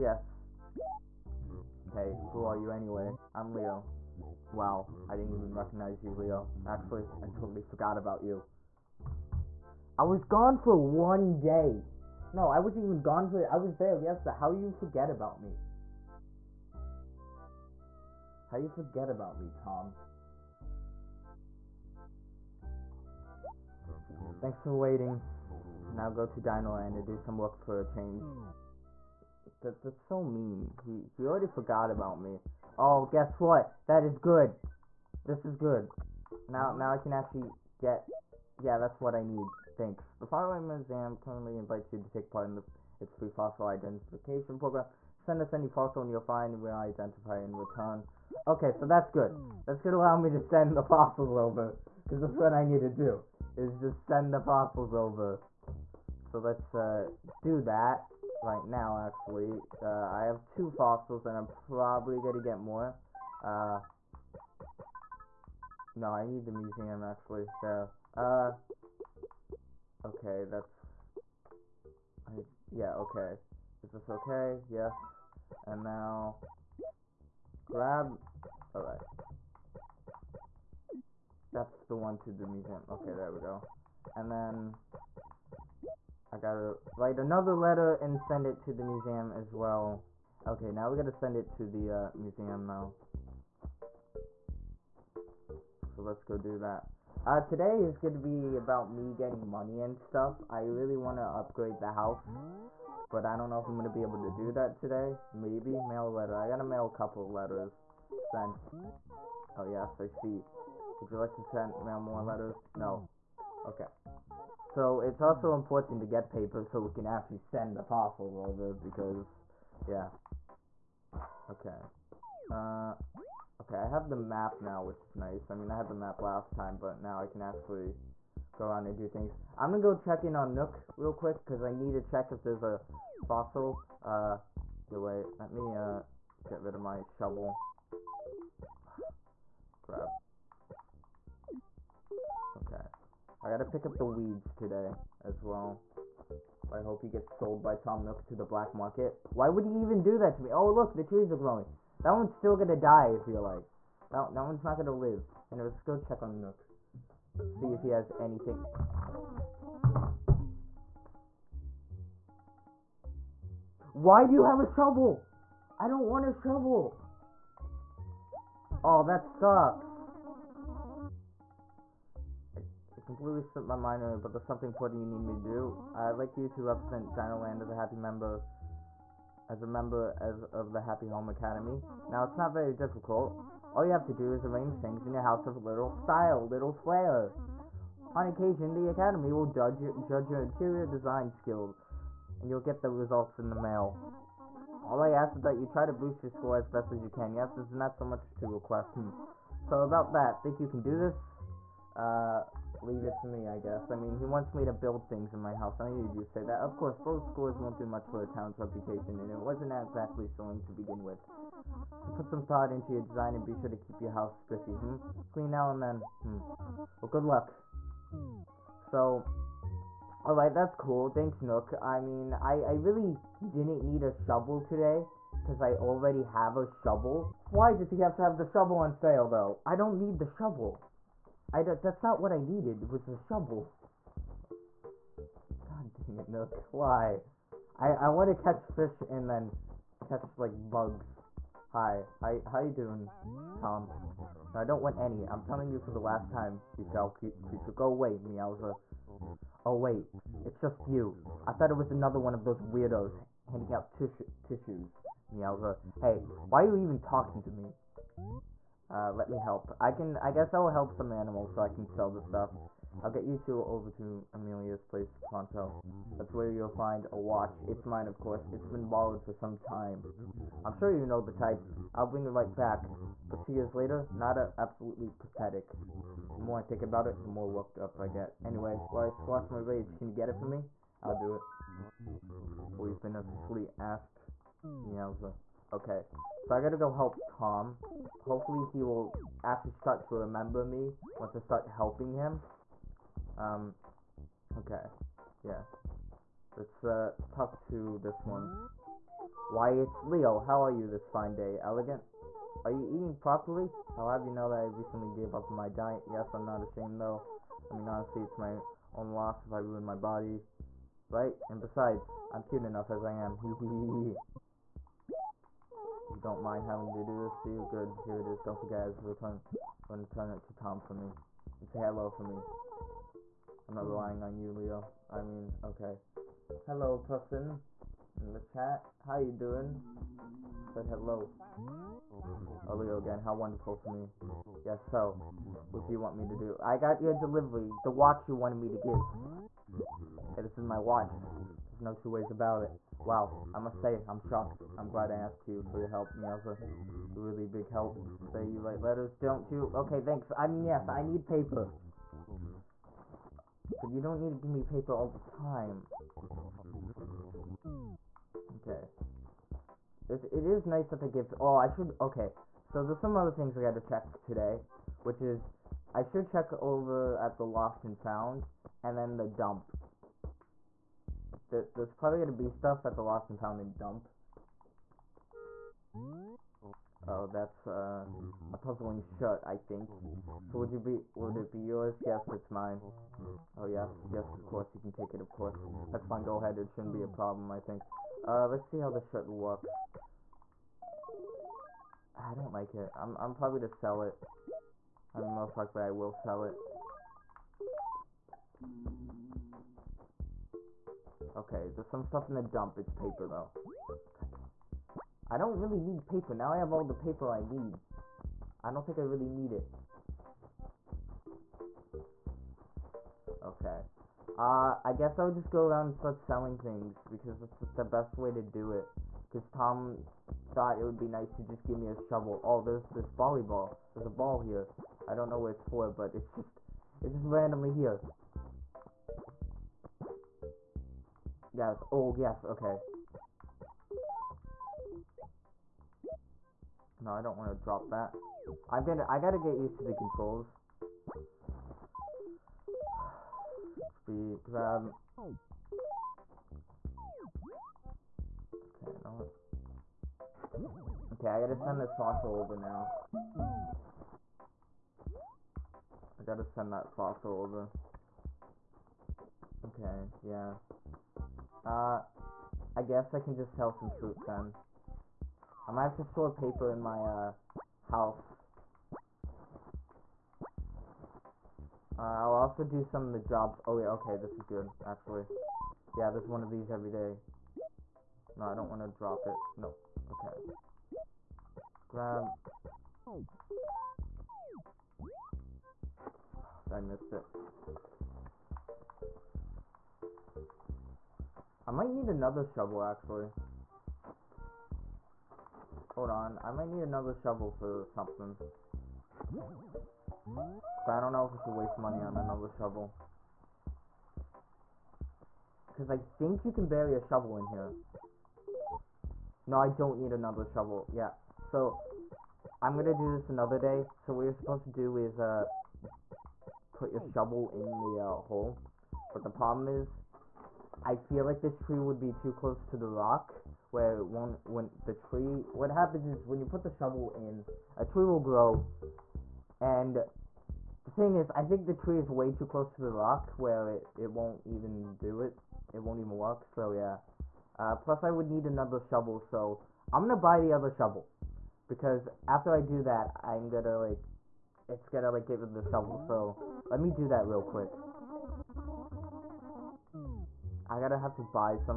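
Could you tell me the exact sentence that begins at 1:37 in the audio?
Uh, today is gonna be about me getting money and stuff.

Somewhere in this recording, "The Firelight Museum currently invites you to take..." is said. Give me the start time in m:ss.
0:40.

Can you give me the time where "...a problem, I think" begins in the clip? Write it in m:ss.
6:27.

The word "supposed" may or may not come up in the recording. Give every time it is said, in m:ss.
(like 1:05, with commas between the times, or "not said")
8:34.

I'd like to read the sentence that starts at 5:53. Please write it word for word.
But you don't need to give me paper all the time.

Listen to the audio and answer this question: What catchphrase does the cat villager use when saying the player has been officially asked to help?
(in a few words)
Yowza.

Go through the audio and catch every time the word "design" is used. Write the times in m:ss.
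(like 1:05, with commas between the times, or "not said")
3:10, 3:33.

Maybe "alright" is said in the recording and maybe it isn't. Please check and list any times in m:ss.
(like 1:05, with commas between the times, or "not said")
1:18, 3:40.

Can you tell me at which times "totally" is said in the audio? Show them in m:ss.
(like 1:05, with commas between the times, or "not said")
0:07.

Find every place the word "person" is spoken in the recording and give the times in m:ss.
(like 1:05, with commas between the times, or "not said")
5:26.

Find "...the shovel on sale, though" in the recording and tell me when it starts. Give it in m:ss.
3:48.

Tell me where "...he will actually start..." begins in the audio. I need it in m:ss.
4:48.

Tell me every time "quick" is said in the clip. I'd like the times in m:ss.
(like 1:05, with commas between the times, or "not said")
2:11, 9:07.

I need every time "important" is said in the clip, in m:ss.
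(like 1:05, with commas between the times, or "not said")
1:55, 2:54.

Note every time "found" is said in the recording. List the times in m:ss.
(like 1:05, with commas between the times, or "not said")
6:07, 6:13.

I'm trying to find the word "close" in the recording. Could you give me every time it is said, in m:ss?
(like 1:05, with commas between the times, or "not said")
8:42, 8:52.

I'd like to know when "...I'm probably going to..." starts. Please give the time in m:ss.
1:01.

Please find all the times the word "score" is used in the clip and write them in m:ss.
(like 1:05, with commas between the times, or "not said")
3:16, 3:27.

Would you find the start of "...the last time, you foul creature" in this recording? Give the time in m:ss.
4:05.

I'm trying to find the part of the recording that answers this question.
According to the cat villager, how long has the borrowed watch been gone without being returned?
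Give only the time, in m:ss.
4:33.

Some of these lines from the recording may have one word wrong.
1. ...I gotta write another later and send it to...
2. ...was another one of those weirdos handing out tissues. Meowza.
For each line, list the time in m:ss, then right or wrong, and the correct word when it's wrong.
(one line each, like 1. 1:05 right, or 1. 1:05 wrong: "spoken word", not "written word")
1. 1:26 wrong: "letter", not "later"
2. 4:11 right.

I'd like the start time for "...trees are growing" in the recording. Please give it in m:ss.
2:31.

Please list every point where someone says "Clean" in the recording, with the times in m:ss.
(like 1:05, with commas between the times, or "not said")
3:35.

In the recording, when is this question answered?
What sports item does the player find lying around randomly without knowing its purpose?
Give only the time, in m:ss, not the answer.
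7:03.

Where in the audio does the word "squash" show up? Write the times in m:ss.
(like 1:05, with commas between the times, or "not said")
4:39.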